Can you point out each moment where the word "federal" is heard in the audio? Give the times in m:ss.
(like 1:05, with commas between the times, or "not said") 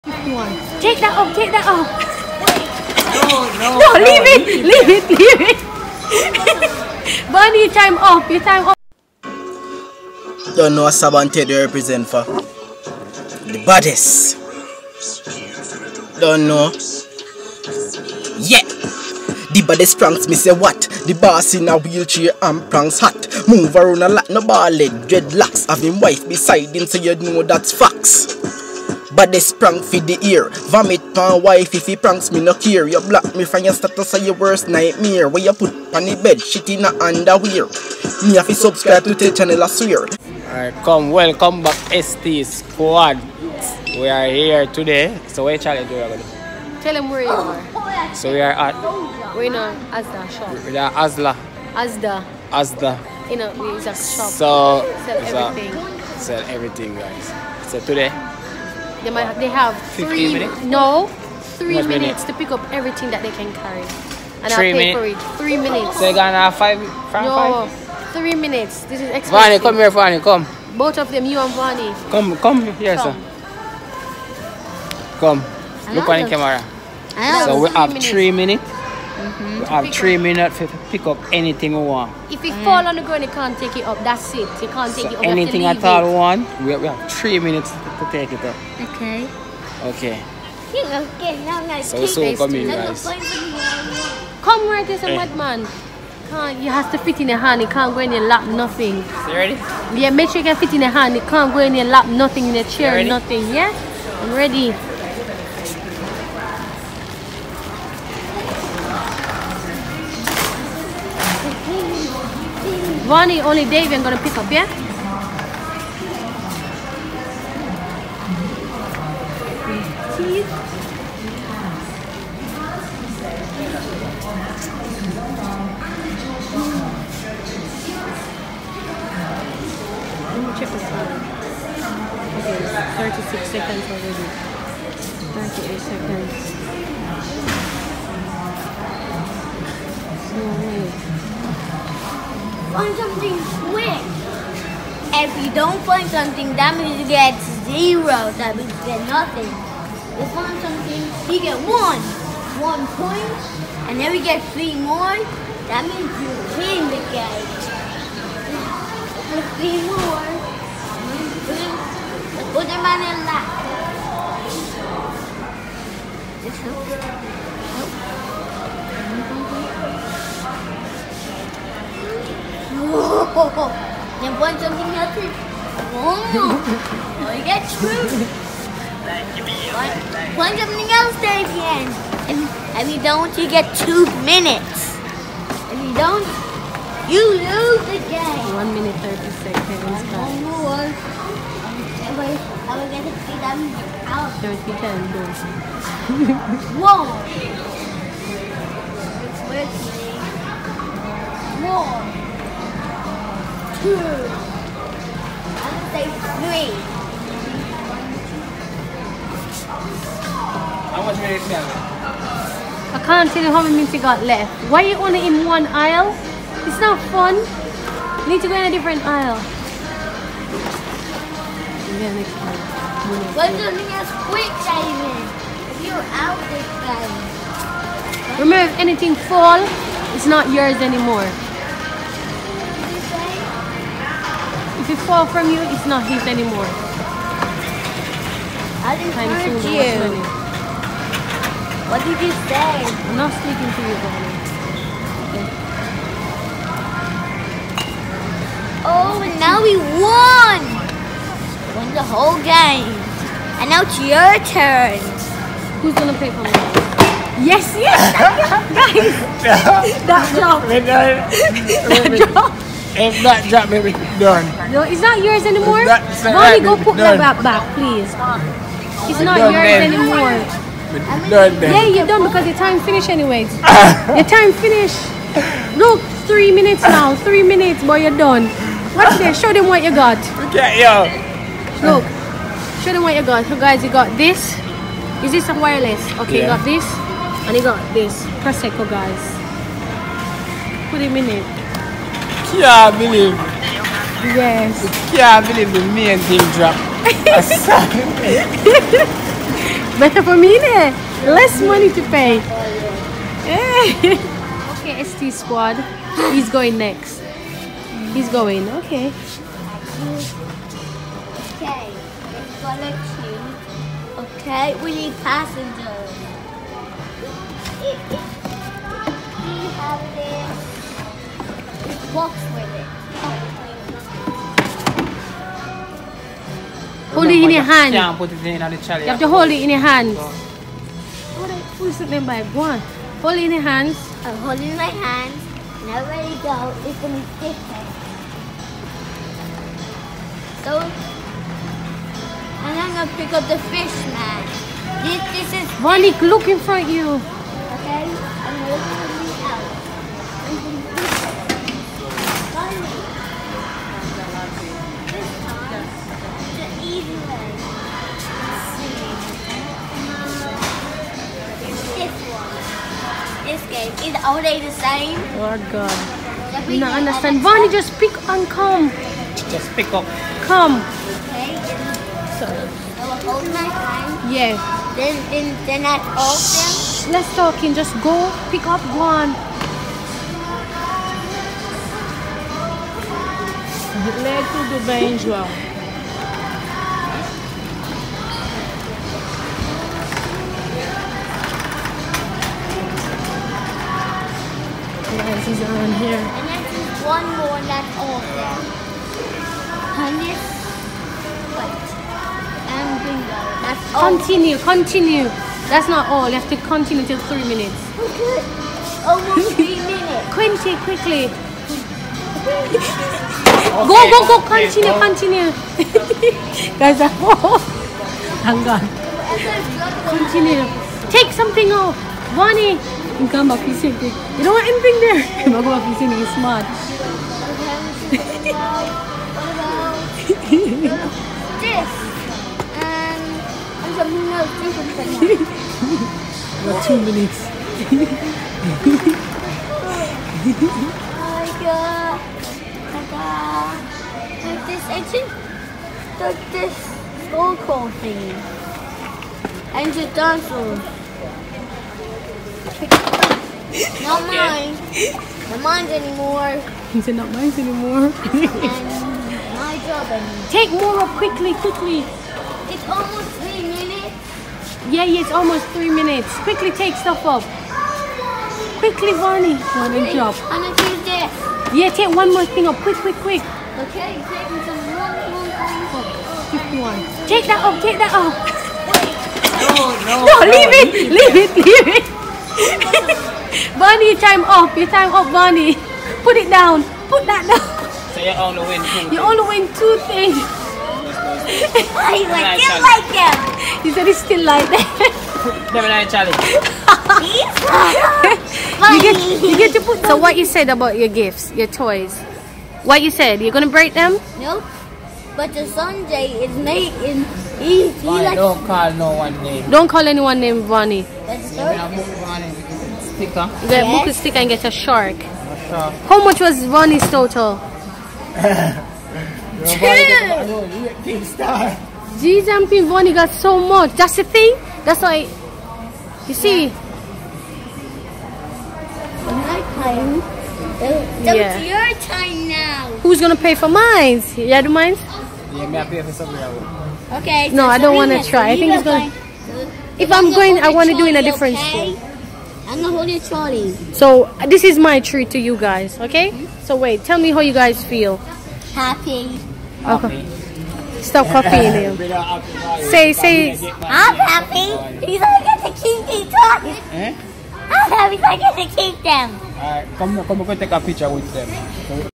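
not said.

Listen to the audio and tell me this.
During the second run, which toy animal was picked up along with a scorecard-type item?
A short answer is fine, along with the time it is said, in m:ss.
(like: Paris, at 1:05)
dinosaur, at 7:29.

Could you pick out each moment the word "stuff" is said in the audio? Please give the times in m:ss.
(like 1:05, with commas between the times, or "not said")
7:46.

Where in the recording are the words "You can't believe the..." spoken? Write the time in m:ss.
4:55.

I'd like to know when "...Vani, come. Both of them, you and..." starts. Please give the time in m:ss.
1:09.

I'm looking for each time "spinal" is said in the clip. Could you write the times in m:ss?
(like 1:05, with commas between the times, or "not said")
not said.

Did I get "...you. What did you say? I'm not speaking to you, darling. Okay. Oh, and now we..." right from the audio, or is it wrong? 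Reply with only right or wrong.
right.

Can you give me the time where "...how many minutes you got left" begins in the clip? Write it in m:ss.
3:33.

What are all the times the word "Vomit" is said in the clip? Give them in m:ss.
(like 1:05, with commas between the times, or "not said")
0:30.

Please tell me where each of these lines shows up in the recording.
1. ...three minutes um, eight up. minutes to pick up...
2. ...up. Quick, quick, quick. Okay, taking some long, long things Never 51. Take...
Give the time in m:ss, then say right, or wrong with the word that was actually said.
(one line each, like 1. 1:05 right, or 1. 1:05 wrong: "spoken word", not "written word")
1. 1:17 wrong: "three", not "eight"
2. 7:52 wrong: "Quick", not "Never".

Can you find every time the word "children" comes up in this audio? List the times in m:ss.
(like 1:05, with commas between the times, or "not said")
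not said.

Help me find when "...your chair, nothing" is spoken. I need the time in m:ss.
1:42.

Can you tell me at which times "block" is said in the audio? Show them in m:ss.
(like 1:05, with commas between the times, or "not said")
0:33.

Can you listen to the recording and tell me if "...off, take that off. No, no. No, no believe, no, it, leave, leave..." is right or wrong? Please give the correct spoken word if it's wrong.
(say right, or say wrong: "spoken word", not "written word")
wrong: "leave", not "believe".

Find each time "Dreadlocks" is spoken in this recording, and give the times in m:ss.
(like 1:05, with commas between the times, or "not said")
0:24.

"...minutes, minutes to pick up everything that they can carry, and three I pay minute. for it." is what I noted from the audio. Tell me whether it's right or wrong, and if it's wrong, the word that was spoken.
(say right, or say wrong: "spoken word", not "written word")
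right.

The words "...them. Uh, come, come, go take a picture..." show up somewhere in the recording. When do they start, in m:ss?
9:19.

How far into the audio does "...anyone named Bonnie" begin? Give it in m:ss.
8:30.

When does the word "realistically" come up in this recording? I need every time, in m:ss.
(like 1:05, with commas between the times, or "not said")
not said.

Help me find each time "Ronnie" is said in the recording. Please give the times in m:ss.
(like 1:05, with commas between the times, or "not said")
8:36, 8:42.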